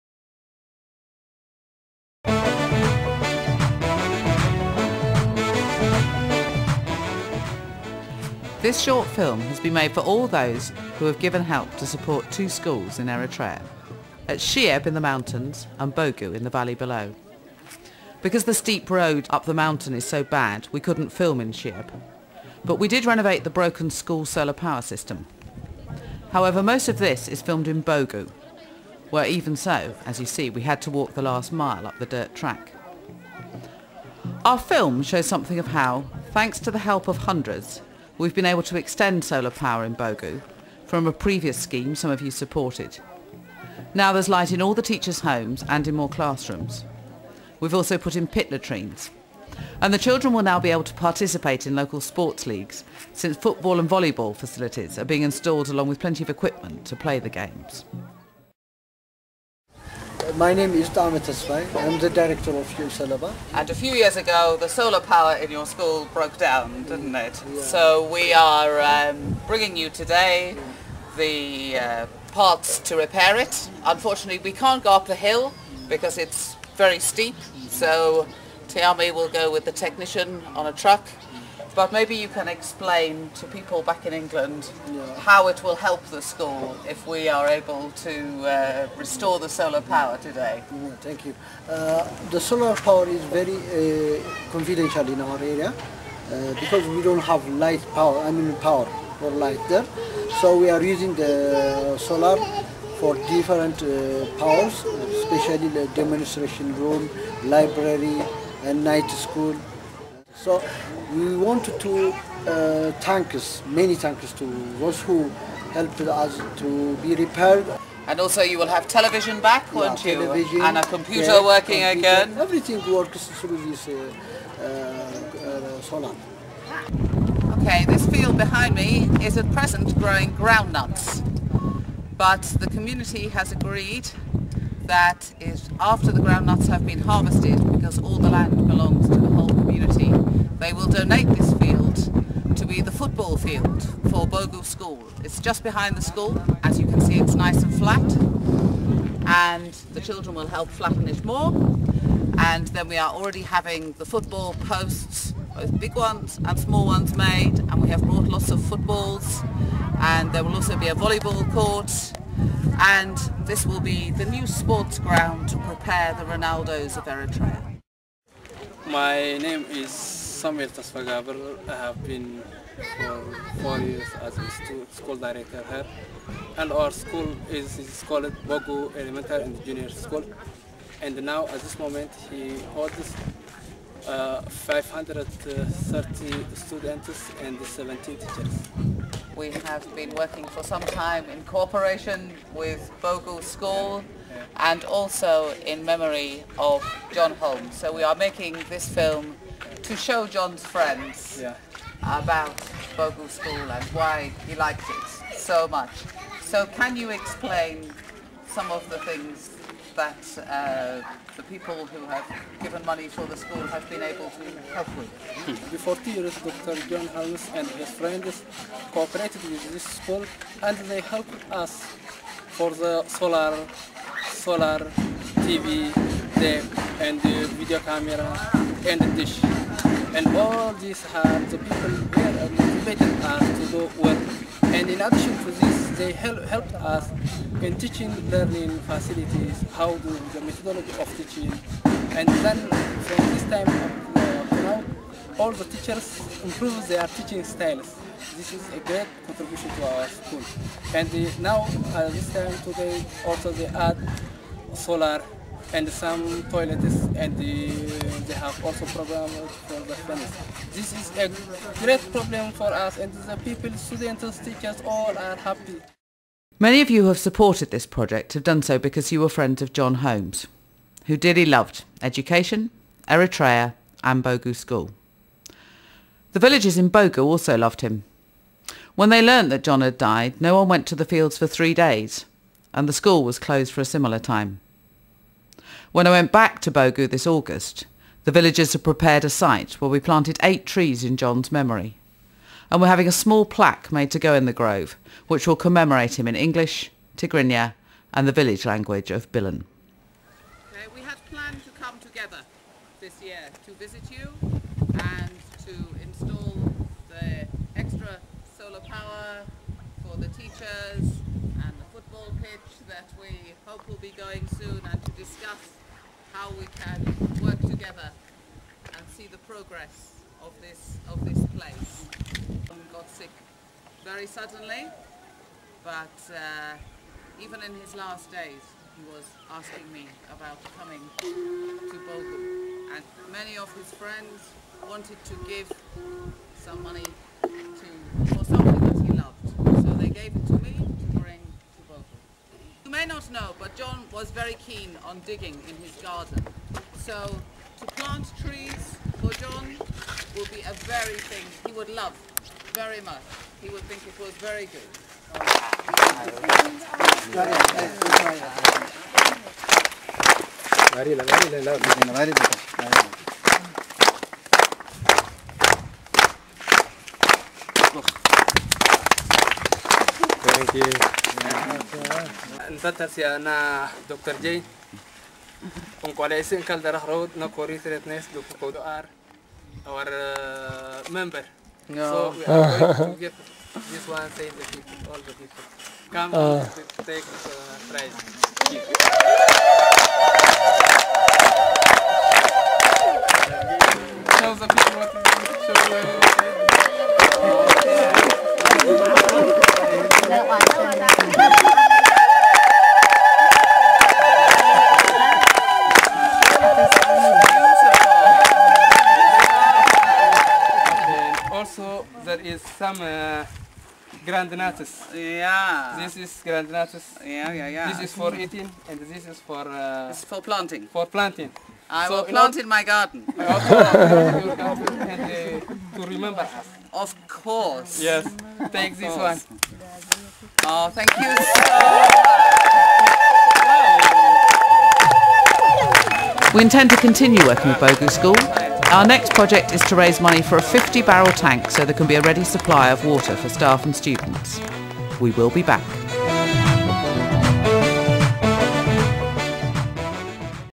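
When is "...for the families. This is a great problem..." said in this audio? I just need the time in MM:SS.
04:19.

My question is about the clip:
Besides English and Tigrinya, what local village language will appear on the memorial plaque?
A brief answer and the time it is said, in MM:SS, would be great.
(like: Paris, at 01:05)
Bilan, at 04:59.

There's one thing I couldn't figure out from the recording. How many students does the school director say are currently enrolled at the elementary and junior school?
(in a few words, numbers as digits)
530.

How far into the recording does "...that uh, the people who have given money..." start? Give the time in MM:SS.
03:29.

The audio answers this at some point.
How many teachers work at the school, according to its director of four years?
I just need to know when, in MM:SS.
03:07.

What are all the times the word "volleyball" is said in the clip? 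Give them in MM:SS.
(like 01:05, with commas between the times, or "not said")
00:53, 02:40.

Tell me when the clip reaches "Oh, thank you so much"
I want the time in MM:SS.
07:10.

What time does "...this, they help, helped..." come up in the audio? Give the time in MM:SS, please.
03:55.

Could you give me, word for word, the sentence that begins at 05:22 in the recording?
Um, got sick very suddenly, but uh, even in his last days, he was asking me about coming to Bogum.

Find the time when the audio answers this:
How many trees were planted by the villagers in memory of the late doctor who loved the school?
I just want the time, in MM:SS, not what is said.
04:50.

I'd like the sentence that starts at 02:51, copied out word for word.
I have been for four years as a school director here.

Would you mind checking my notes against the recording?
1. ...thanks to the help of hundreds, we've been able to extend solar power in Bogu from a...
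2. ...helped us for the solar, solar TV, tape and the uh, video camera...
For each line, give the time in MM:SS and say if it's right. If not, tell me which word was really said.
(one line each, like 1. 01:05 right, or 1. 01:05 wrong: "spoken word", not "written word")
1. 00:36 right
2. 03:41 right.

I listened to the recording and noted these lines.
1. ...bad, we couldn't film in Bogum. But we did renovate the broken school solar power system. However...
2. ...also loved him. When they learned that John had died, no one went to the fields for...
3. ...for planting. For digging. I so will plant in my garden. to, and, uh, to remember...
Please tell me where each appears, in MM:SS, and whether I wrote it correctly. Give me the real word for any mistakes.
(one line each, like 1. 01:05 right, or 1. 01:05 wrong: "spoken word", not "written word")
1. 00:20 wrong: "Sheeb", not "Bogum"
2. 04:37 right
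3. 07:00 wrong: "planting", not "digging".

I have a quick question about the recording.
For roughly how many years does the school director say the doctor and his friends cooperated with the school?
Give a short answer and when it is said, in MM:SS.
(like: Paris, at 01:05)
40 years, at 03:36.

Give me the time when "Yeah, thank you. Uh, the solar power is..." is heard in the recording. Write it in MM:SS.
01:30.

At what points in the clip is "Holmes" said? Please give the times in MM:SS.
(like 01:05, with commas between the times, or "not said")
03:17, 03:37, 04:29.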